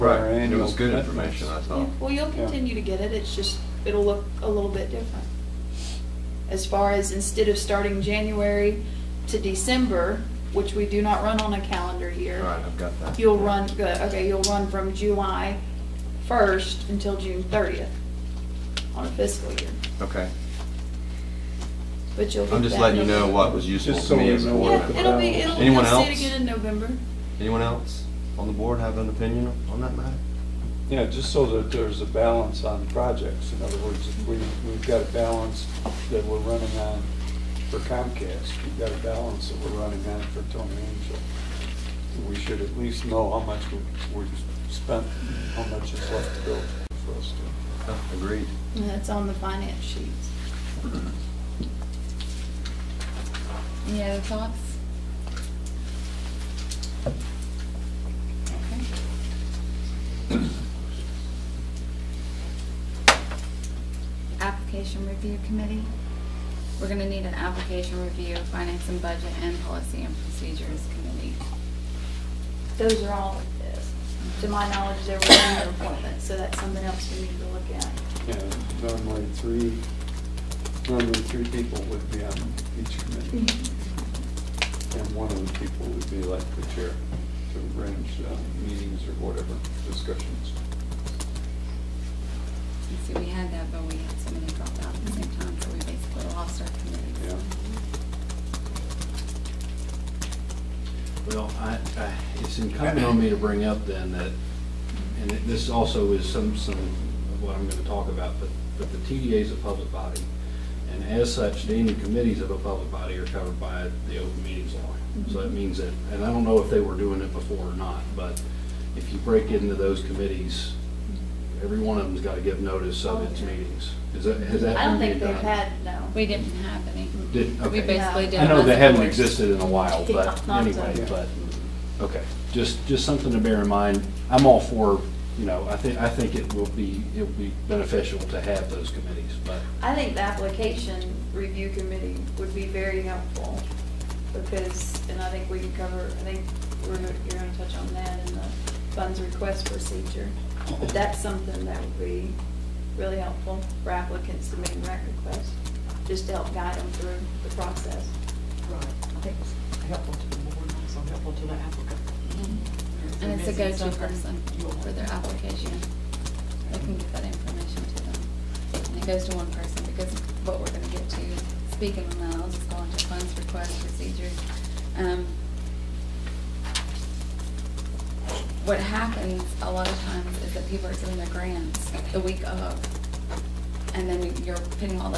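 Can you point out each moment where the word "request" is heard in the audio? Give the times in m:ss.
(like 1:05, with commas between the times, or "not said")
2:29, 2:35, 2:53.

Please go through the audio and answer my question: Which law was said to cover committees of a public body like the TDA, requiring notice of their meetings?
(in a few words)
open meetings law.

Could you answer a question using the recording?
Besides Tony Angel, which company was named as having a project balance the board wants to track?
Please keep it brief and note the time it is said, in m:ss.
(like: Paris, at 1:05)
Comcast, at 0:37.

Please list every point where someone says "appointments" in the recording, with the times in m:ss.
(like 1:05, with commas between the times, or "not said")
1:15.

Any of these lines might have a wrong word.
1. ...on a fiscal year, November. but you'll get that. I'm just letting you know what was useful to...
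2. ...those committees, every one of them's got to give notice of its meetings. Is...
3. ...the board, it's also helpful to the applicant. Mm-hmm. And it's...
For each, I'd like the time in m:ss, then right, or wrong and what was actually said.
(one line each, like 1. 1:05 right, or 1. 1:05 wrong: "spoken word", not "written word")
1. 0:18 wrong: "Okay", not "November"
2. 1:59 right
3. 2:40 right.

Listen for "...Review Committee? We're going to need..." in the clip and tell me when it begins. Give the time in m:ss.
1:05.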